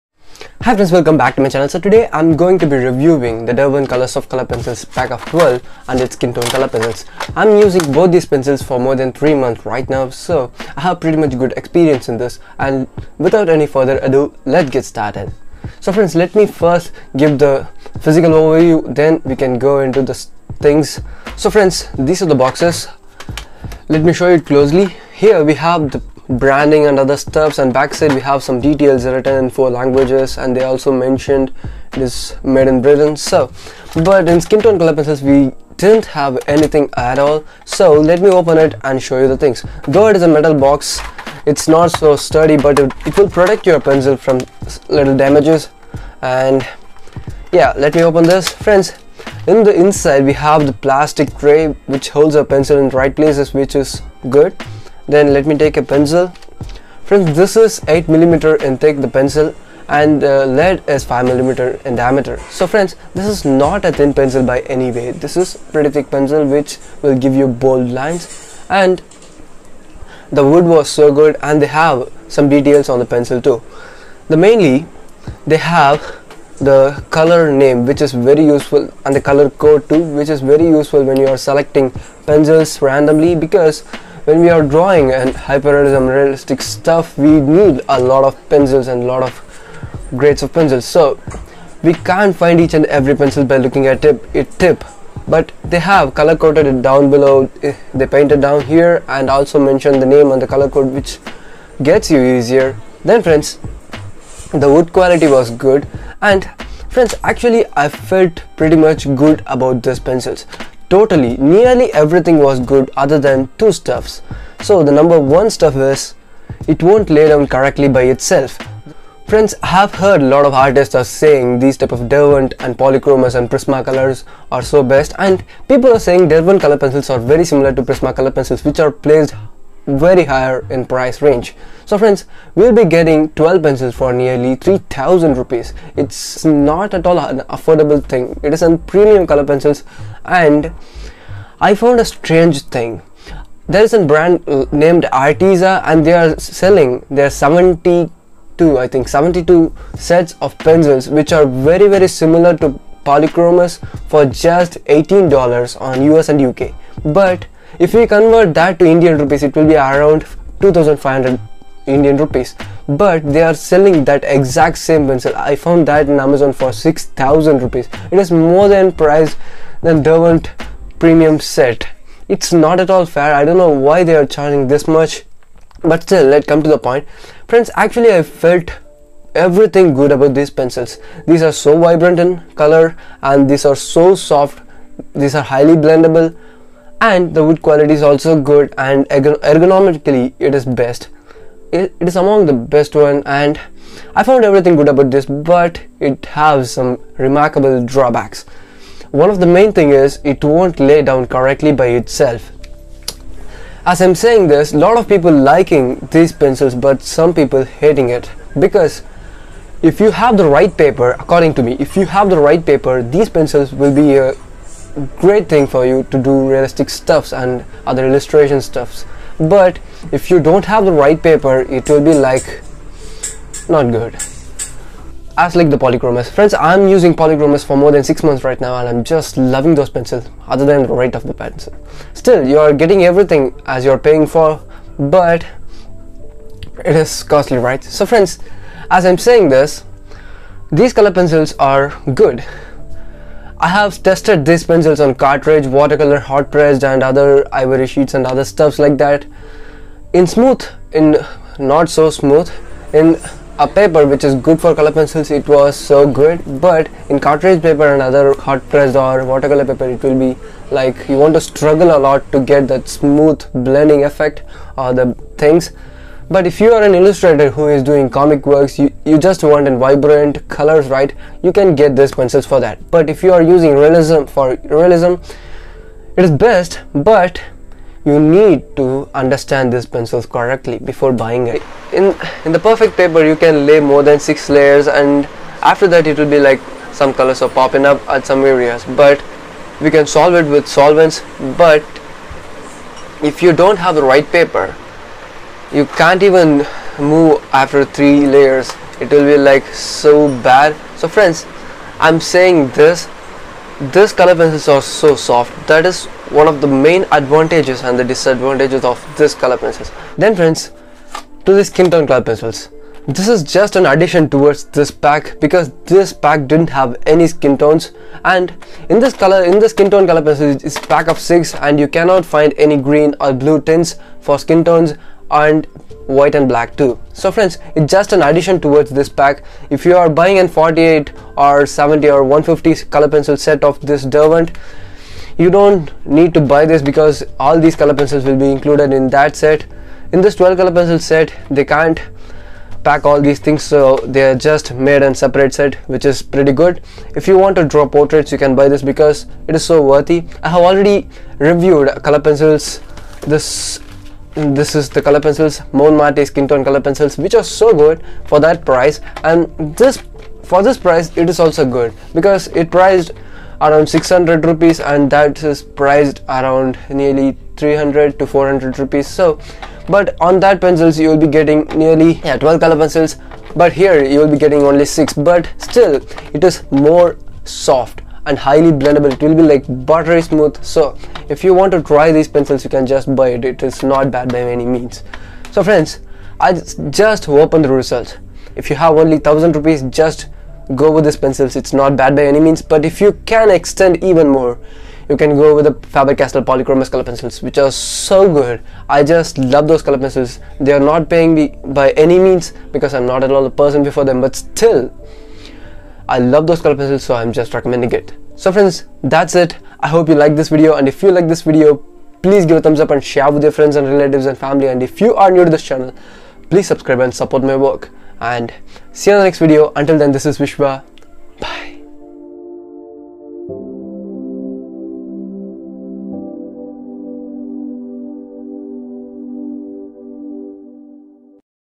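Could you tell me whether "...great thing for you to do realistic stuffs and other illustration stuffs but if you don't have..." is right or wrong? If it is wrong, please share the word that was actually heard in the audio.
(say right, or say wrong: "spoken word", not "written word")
right.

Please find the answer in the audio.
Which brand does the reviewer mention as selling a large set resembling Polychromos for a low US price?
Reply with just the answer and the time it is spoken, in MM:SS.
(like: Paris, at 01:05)
Arteza, at 02:25.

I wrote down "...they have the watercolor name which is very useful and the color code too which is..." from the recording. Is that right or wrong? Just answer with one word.
wrong.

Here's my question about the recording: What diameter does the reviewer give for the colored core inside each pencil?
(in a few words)
5 millimeter.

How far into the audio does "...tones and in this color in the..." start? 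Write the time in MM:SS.
05:17.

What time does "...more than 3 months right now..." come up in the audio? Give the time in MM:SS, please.
00:08.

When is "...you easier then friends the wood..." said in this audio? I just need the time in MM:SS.
01:42.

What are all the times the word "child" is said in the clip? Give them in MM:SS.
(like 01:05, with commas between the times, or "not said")
not said.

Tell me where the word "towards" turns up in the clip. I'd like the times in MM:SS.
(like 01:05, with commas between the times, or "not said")
05:14, 05:28.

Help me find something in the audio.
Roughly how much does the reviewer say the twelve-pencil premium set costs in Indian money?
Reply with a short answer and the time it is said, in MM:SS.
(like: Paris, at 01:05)
3000 rupees, at 02:14.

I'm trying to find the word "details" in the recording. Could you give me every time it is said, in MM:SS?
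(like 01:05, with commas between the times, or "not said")
00:28, 01:12.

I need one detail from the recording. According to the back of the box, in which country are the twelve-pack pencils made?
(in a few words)
Britain.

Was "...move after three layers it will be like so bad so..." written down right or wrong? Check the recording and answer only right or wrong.
right.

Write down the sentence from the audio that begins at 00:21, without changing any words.
So friends, these are the boxes.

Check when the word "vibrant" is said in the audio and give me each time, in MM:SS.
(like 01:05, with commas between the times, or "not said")
03:01, 04:29.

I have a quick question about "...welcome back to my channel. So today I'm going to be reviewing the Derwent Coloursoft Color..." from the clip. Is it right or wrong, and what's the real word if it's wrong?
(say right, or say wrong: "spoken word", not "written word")
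right.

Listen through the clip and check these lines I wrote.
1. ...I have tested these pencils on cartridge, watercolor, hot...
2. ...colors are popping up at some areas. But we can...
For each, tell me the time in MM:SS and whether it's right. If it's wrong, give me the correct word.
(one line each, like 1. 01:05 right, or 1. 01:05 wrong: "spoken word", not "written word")
1. 04:03 right
2. 04:47 right.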